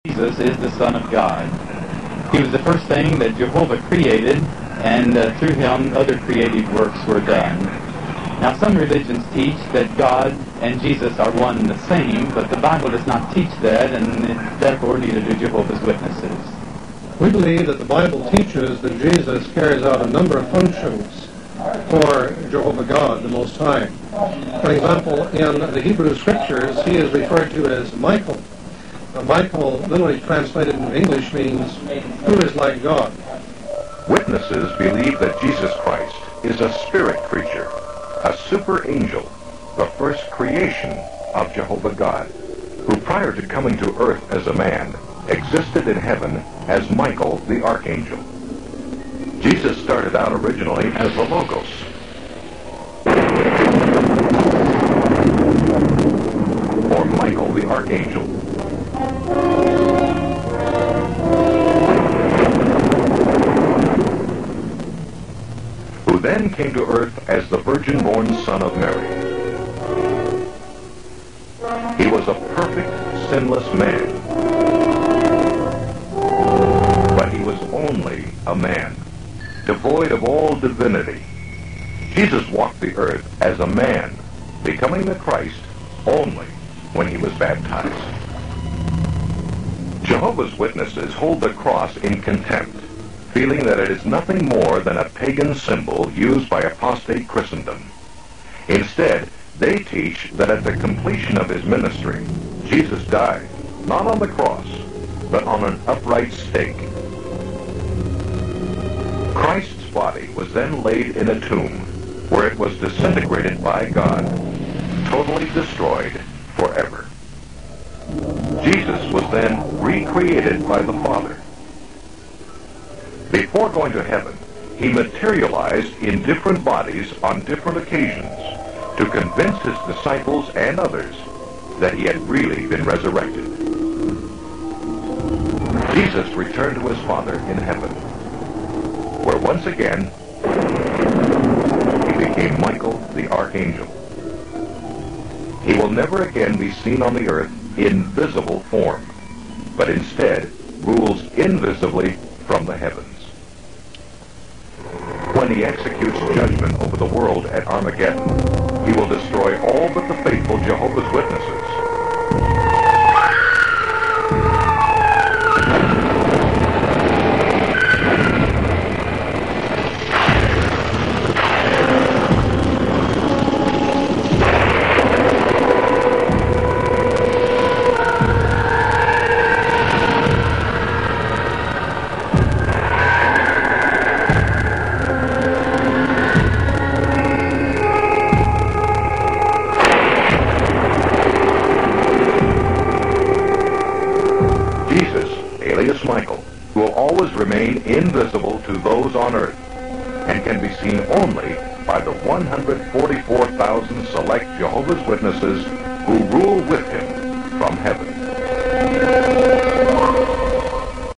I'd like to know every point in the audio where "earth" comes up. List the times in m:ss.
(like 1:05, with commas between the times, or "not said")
0:44, 1:06, 1:22, 2:27, 3:19.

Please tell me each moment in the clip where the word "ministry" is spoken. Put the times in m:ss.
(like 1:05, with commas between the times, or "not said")
1:41.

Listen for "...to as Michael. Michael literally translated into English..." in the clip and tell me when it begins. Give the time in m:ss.
0:27.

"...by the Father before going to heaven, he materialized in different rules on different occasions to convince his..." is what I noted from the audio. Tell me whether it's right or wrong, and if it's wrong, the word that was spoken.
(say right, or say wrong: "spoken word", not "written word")
wrong: "bodies", not "rules".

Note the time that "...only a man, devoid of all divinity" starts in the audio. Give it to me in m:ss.
1:17.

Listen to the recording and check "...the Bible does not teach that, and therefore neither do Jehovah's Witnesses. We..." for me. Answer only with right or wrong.
right.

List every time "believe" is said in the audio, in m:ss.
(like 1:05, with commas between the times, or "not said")
0:17, 0:34.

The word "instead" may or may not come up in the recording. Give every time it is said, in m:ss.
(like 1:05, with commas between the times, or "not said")
1:38, 2:29.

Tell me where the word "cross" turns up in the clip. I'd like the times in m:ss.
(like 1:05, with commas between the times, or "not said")
1:31, 1:44.